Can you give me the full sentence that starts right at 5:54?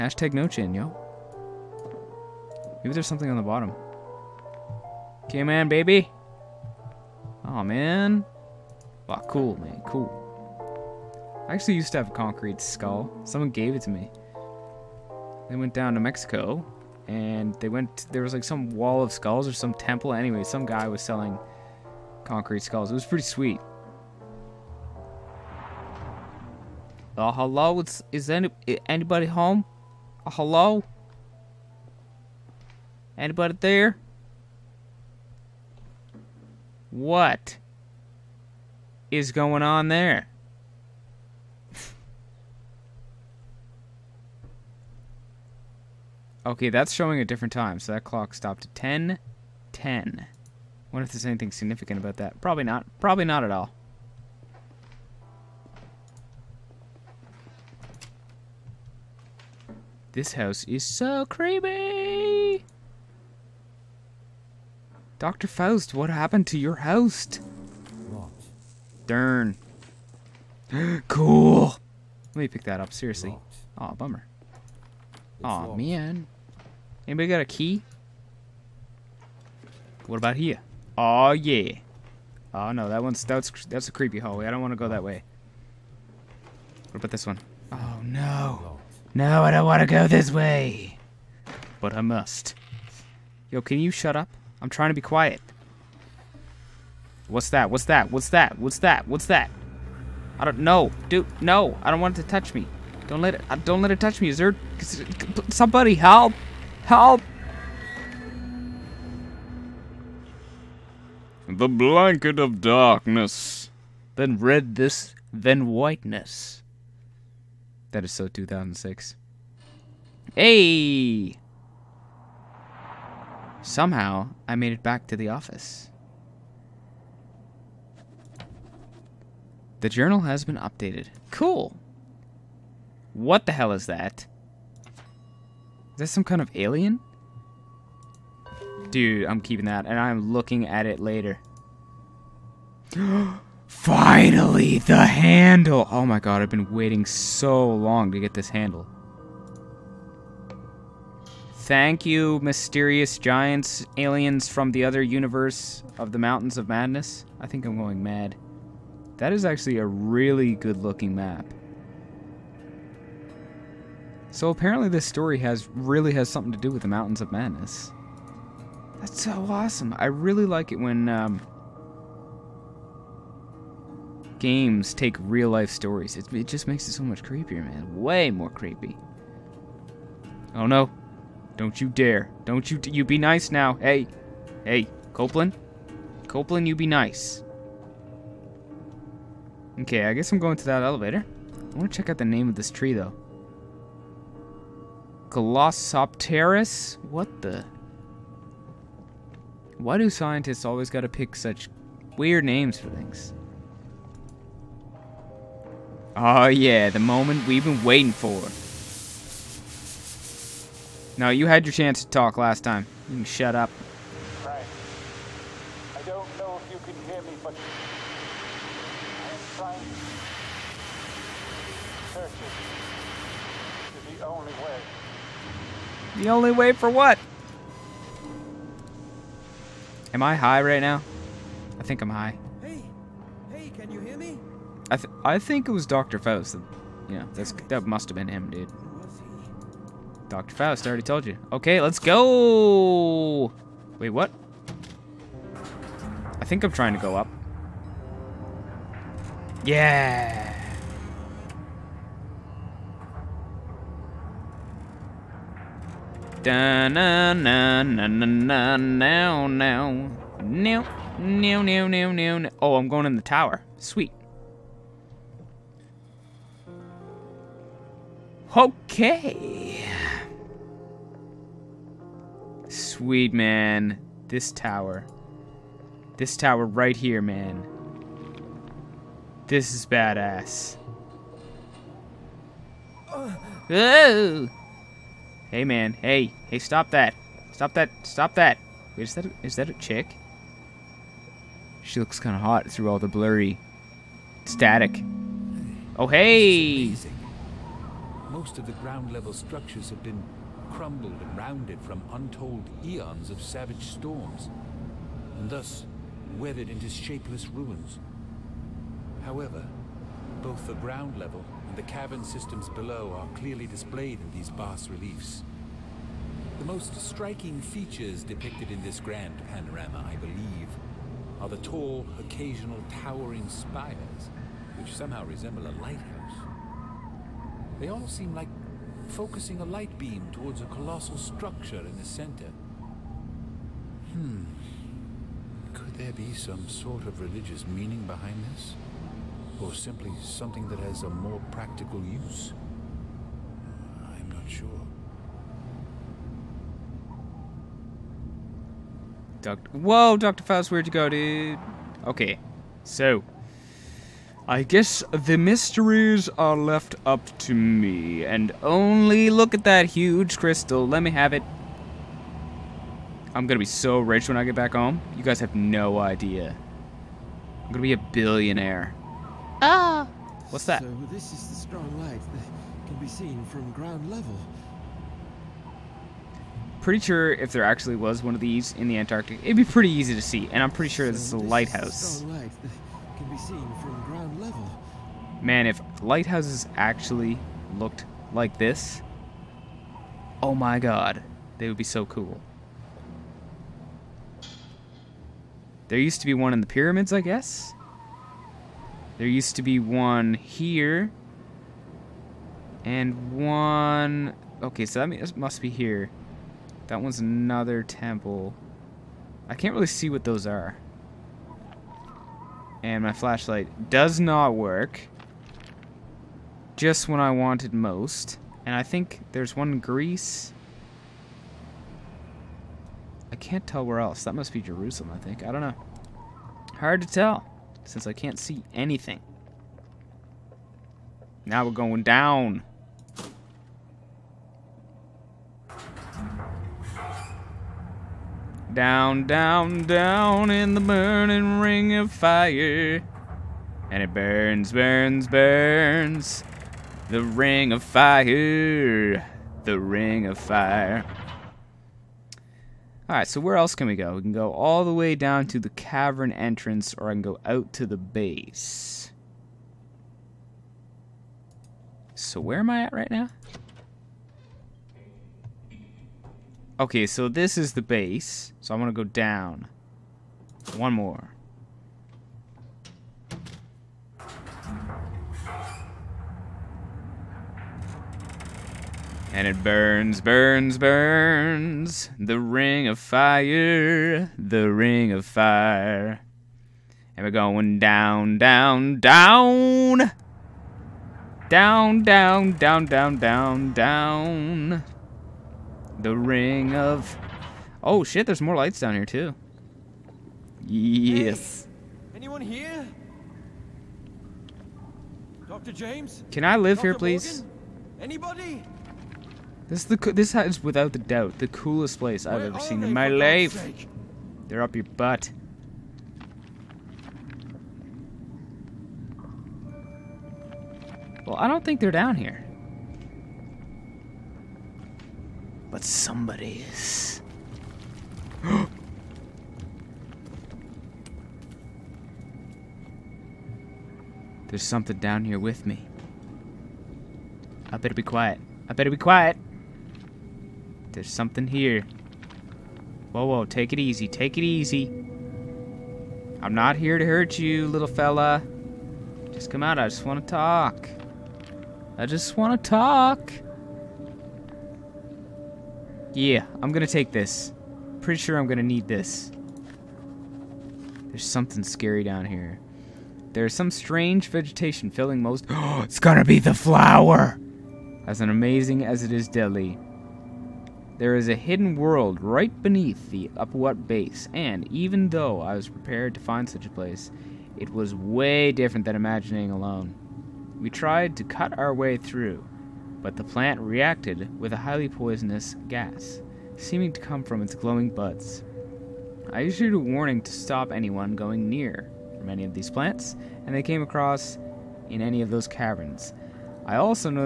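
I guess the mysteries are left up to me, and only look at that huge crystal.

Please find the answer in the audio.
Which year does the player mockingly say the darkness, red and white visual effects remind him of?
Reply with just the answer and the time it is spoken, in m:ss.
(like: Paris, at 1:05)
2006, at 1:58.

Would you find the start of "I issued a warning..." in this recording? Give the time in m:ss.
9:49.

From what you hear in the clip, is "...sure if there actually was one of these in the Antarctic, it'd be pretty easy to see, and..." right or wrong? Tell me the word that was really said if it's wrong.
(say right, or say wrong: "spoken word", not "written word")
right.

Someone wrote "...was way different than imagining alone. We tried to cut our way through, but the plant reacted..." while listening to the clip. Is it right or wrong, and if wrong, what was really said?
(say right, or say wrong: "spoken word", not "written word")
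right.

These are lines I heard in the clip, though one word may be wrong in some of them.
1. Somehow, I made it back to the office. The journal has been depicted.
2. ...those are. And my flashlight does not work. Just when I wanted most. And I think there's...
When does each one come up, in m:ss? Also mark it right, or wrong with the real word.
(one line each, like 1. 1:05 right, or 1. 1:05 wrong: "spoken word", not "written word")
1. 2:03 wrong: "updated", not "depicted"
2. 6:50 right.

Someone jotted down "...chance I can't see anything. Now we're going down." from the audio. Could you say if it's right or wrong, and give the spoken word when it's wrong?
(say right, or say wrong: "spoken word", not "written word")
wrong: "since", not "chance".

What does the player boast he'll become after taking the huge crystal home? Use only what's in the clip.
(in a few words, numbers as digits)
billionaire.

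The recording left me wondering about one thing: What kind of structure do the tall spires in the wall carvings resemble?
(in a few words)
a lighthouse.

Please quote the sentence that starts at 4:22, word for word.
Oh, I'm going in the tower.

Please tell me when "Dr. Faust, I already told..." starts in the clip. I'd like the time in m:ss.
4:00.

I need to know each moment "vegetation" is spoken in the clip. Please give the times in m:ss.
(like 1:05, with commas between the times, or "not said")
9:24.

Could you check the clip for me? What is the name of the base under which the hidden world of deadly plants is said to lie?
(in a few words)
Upuaut base.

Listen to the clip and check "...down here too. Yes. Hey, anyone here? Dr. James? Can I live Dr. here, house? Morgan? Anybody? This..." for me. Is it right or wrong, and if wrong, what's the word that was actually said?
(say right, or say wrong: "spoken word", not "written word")
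wrong: "please", not "house".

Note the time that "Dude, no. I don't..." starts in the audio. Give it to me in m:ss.
1:41.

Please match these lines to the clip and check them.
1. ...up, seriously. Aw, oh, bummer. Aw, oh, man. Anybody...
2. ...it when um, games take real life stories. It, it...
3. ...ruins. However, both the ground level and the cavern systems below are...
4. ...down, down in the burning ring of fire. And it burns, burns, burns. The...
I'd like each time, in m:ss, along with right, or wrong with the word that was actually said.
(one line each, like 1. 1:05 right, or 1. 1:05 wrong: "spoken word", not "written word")
1. 1:12 right
2. 2:50 right
3. 5:07 right
4. 7:19 right.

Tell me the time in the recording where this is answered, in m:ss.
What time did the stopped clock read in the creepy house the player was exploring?
0:48.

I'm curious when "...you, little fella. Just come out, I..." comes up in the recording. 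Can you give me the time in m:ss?
9:07.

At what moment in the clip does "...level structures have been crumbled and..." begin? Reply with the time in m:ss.
4:59.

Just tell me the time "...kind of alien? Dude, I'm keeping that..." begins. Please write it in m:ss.
2:16.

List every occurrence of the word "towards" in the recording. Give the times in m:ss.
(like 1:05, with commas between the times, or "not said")
5:30.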